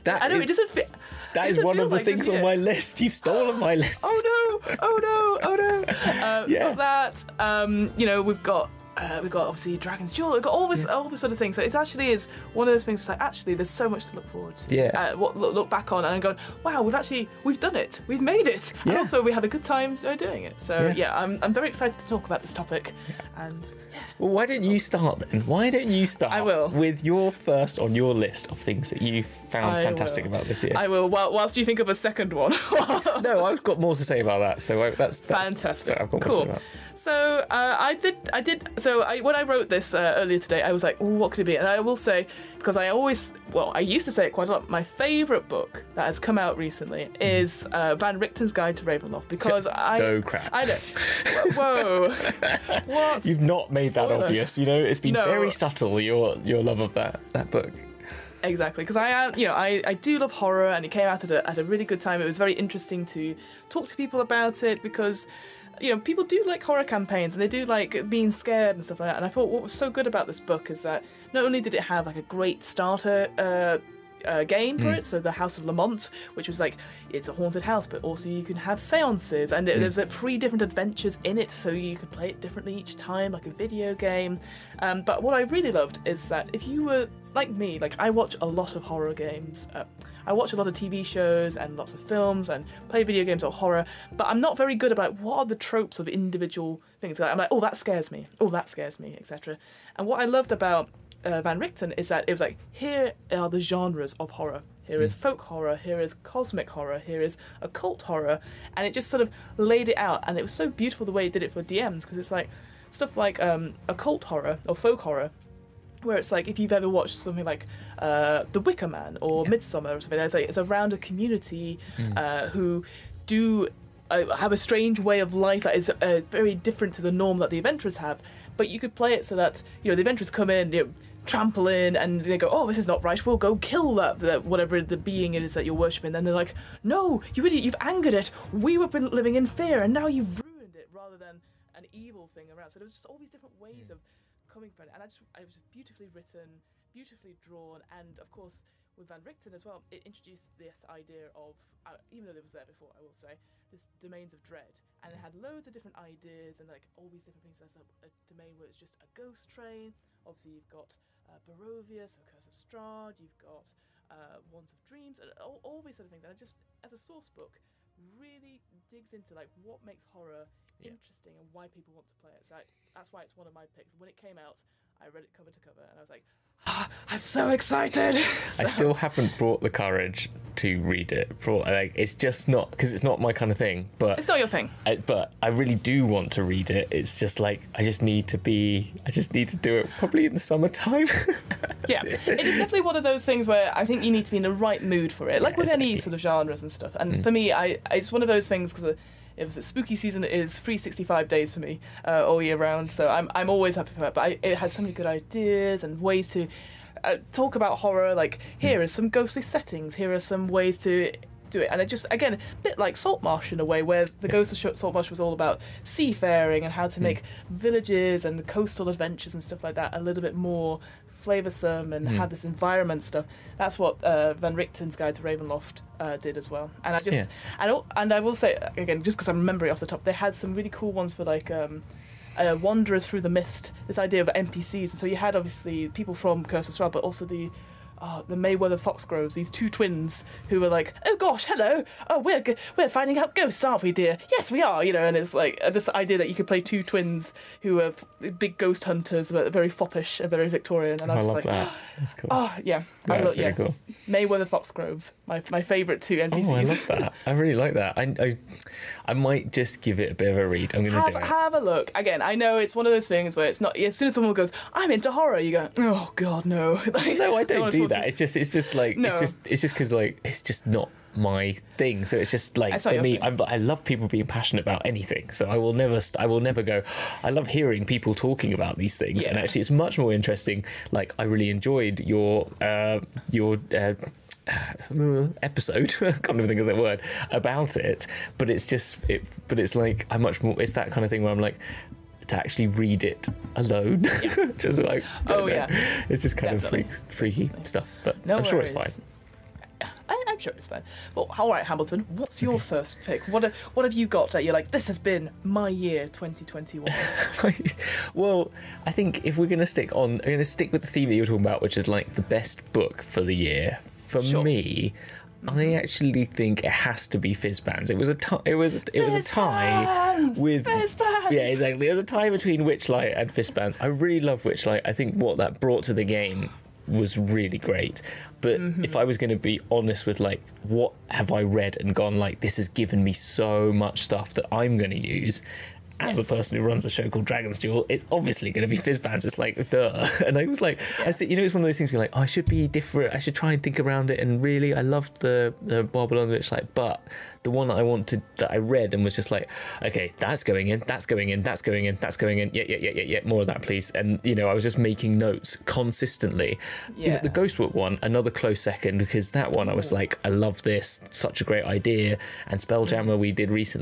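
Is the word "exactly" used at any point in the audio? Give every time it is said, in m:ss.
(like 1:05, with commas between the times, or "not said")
0:58, 3:15, 5:21.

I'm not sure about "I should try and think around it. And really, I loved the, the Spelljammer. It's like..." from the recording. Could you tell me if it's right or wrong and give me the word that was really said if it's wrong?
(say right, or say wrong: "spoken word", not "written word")
wrong: "Babylon", not "Spelljammer".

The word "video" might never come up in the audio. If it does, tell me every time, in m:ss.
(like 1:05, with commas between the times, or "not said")
1:23, 1:33.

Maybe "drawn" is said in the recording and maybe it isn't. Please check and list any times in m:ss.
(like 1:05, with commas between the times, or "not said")
2:27.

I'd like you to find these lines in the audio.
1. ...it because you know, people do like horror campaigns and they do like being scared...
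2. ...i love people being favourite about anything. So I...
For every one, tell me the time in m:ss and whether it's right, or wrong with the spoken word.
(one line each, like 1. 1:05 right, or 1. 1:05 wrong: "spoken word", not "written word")
1. 1:04 right
2. 4:33 wrong: "passionate", not "favourite".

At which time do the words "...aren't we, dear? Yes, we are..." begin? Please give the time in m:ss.
4:03.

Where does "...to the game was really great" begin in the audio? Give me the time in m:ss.
5:25.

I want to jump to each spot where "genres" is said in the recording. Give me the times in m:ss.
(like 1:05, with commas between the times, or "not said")
1:43, 3:16.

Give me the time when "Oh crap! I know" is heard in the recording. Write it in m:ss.
0:50.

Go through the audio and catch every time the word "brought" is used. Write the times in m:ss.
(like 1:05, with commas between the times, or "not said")
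2:59, 5:25.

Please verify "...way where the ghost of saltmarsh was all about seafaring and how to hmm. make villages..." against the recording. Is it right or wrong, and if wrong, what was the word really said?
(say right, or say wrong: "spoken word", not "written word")
right.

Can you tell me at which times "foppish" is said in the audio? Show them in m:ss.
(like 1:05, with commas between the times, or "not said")
4:09.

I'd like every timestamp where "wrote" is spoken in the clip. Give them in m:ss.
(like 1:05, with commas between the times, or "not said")
0:39.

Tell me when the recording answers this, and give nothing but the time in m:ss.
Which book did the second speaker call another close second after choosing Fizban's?
5:57.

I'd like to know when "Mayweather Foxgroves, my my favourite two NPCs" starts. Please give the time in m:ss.
4:14.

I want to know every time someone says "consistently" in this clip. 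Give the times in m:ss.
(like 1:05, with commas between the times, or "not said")
5:55.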